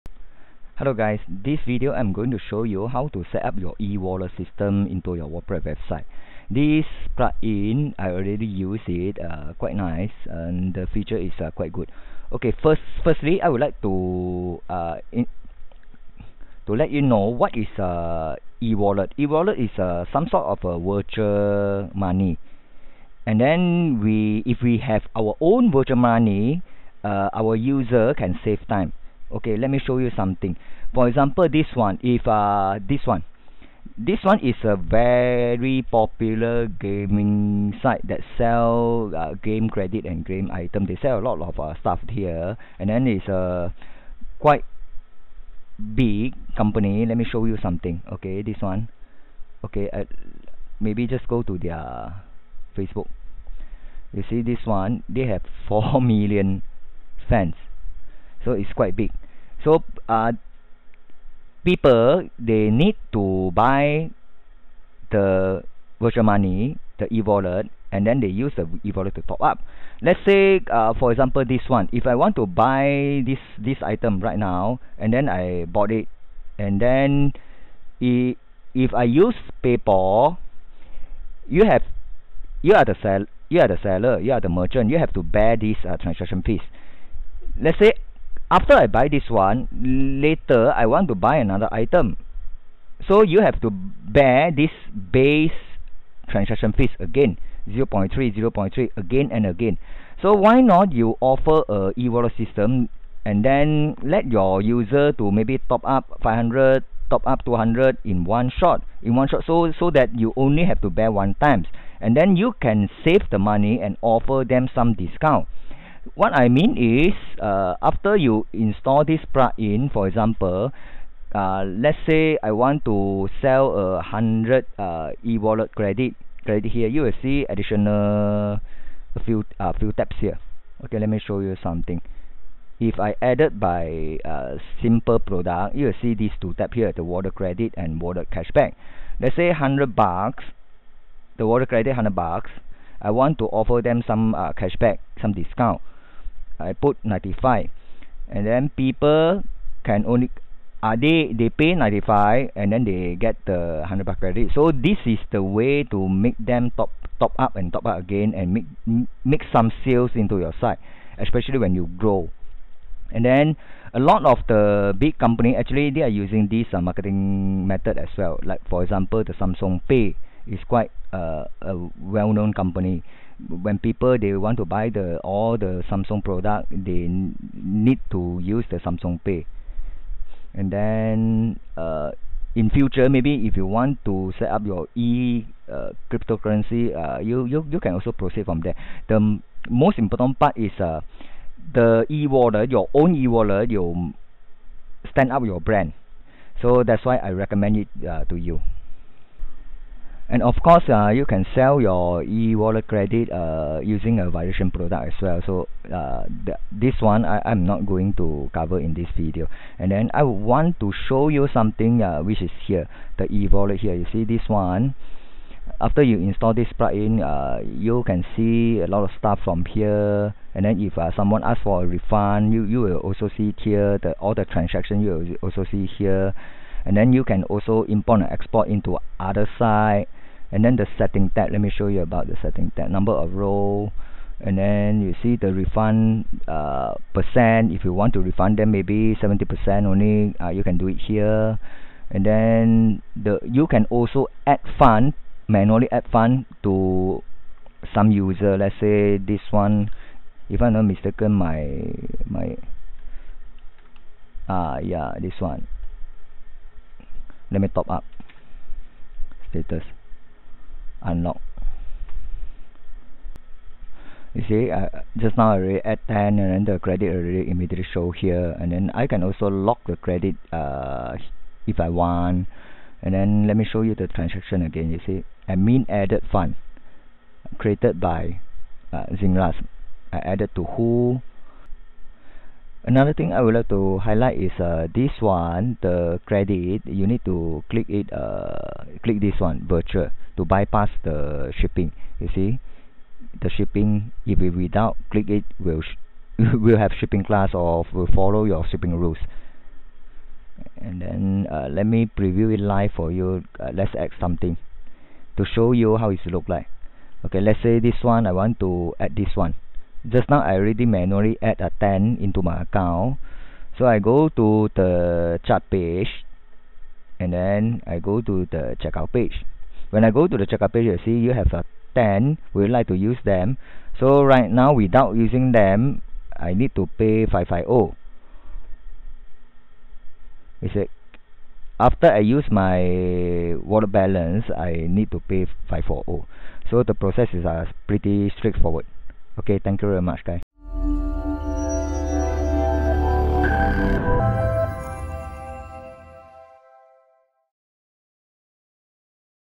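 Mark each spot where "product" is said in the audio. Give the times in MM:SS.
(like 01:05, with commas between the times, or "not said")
02:15, 02:56, 03:24.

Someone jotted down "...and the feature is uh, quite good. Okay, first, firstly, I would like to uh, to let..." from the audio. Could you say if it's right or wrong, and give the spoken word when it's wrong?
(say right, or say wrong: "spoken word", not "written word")
right.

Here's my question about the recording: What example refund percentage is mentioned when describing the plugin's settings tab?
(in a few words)
70%.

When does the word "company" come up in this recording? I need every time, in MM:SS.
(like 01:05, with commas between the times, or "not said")
00:46, 02:45, 02:52.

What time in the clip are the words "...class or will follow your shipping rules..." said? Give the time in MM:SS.
04:57.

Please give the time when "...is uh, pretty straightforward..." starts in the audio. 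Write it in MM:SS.
05:37.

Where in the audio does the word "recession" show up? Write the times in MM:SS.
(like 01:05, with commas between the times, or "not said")
not said.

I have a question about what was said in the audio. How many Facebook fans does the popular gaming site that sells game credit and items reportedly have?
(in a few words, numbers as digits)
4 million.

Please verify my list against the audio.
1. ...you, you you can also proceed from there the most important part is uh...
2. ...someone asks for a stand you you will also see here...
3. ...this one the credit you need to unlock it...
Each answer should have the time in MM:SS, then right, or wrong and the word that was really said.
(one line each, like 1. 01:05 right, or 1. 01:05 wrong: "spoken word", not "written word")
1. 03:07 right
2. 03:41 wrong: "refund", not "stand"
3. 04:44 wrong: "click", not "unlock".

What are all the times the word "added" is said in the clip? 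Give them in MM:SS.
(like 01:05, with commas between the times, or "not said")
02:13, 04:35, 04:40.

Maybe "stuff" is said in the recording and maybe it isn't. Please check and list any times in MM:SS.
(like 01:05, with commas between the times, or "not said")
00:41, 03:39.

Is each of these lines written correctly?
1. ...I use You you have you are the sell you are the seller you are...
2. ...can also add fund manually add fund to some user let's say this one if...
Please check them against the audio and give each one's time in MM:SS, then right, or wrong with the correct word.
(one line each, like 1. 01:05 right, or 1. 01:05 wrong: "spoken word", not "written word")
1. 01:18 wrong: "PayPal", not "You"
2. 04:03 right.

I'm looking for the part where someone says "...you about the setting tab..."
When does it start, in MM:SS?
03:51.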